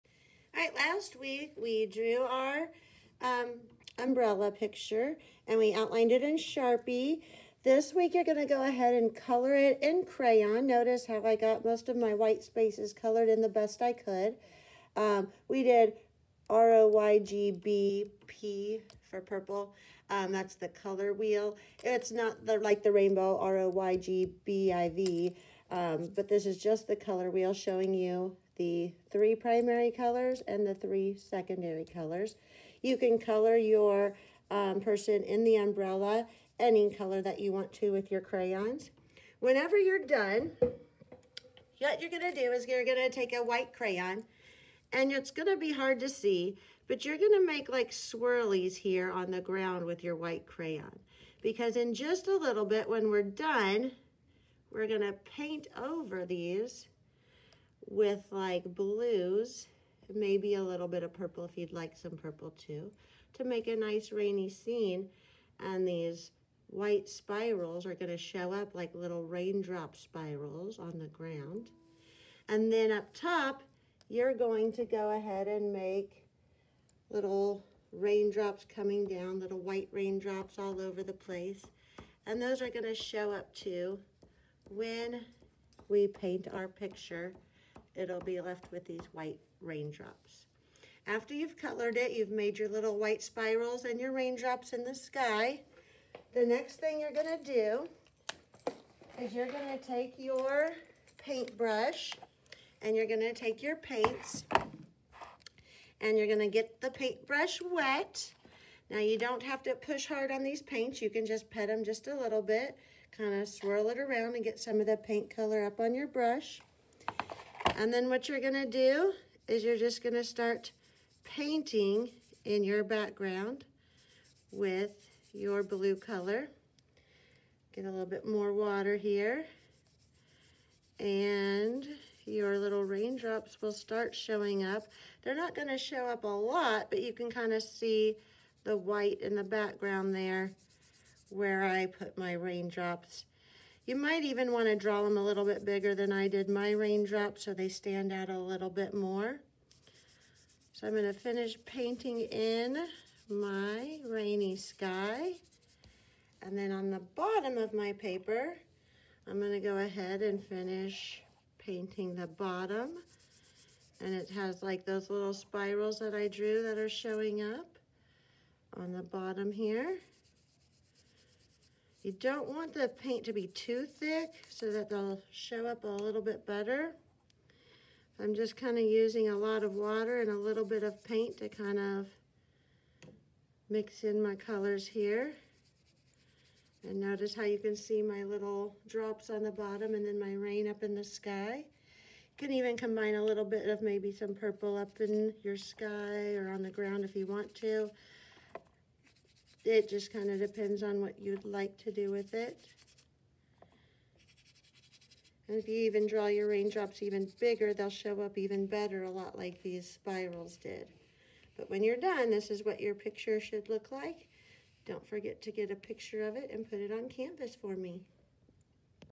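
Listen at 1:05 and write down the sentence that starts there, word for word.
And these white spirals are gonna show up like little raindrop spirals on the ground.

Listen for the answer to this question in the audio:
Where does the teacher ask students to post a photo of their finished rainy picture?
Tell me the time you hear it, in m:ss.
3:37.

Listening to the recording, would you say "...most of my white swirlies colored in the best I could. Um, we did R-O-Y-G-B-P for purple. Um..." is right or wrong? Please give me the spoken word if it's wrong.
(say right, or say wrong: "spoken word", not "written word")
wrong: "spaces", not "swirlies".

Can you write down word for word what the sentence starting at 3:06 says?
And notice how you can see my little drops on the bottom and then my rain up in the sky.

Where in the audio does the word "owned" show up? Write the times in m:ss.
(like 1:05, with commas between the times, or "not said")
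not said.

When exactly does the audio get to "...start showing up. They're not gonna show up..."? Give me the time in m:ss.
2:13.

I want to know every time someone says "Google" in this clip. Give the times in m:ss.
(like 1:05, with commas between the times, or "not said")
not said.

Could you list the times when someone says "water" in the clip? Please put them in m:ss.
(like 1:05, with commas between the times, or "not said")
2:08, 2:59.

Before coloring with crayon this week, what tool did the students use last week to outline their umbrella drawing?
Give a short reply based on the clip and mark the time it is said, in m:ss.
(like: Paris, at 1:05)
Sharpie, at 0:06.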